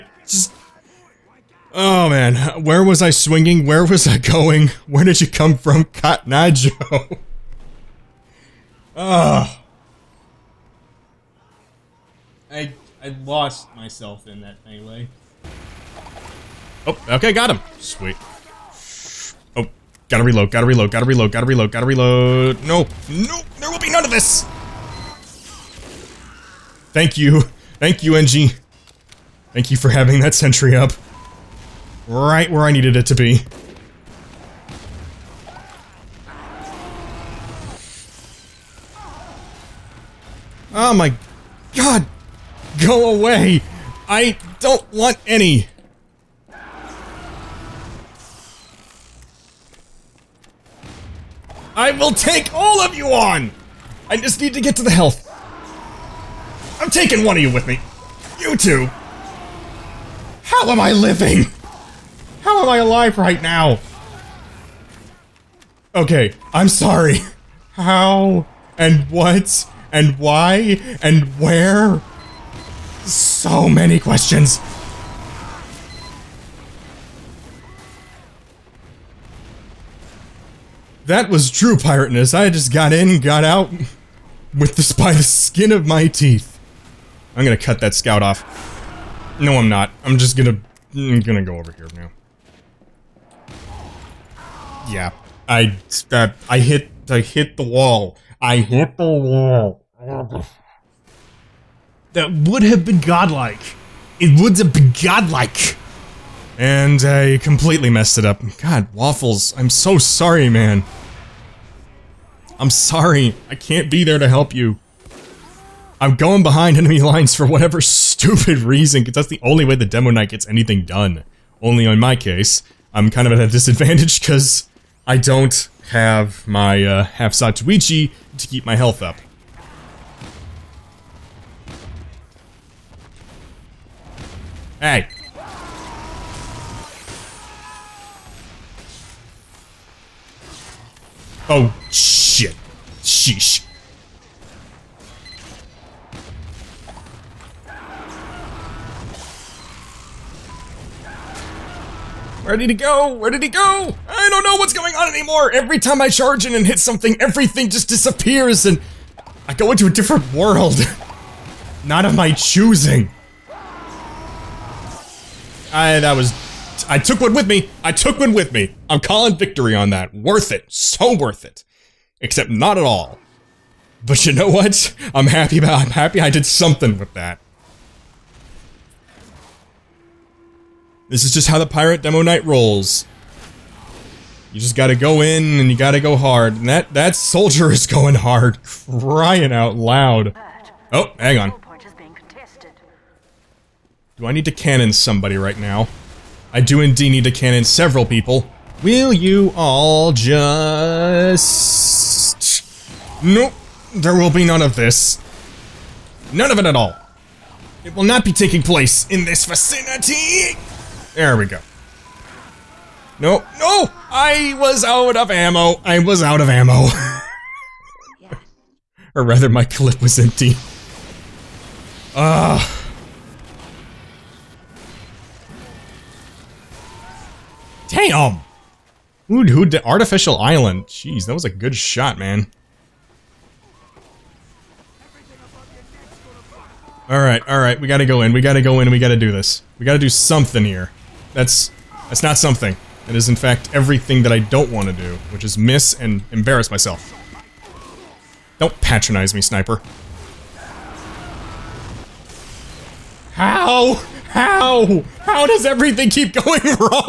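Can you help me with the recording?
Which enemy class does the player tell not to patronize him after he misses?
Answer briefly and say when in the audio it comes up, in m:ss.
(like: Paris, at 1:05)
Sniper, at 4:09.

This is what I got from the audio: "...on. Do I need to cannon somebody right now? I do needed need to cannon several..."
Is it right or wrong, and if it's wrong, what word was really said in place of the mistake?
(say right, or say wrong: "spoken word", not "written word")
wrong: "indeed", not "needed".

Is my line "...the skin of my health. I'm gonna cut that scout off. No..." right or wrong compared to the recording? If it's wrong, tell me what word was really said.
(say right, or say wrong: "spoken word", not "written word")
wrong: "teeth", not "health".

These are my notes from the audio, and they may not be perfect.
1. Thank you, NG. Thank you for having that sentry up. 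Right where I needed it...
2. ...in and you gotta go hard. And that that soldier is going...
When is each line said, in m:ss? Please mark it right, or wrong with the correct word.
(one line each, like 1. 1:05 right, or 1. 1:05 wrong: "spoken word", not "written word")
1. 0:27 right
2. 3:05 right.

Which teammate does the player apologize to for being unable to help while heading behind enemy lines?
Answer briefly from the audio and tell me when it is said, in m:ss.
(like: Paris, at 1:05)
Waffles, at 1:48.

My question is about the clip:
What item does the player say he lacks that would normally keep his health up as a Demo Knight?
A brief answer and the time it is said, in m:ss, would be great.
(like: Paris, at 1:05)
Half Zatoichi, at 2:07.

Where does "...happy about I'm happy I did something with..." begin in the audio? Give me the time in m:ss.
2:55.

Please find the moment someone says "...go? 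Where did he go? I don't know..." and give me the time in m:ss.
2:32.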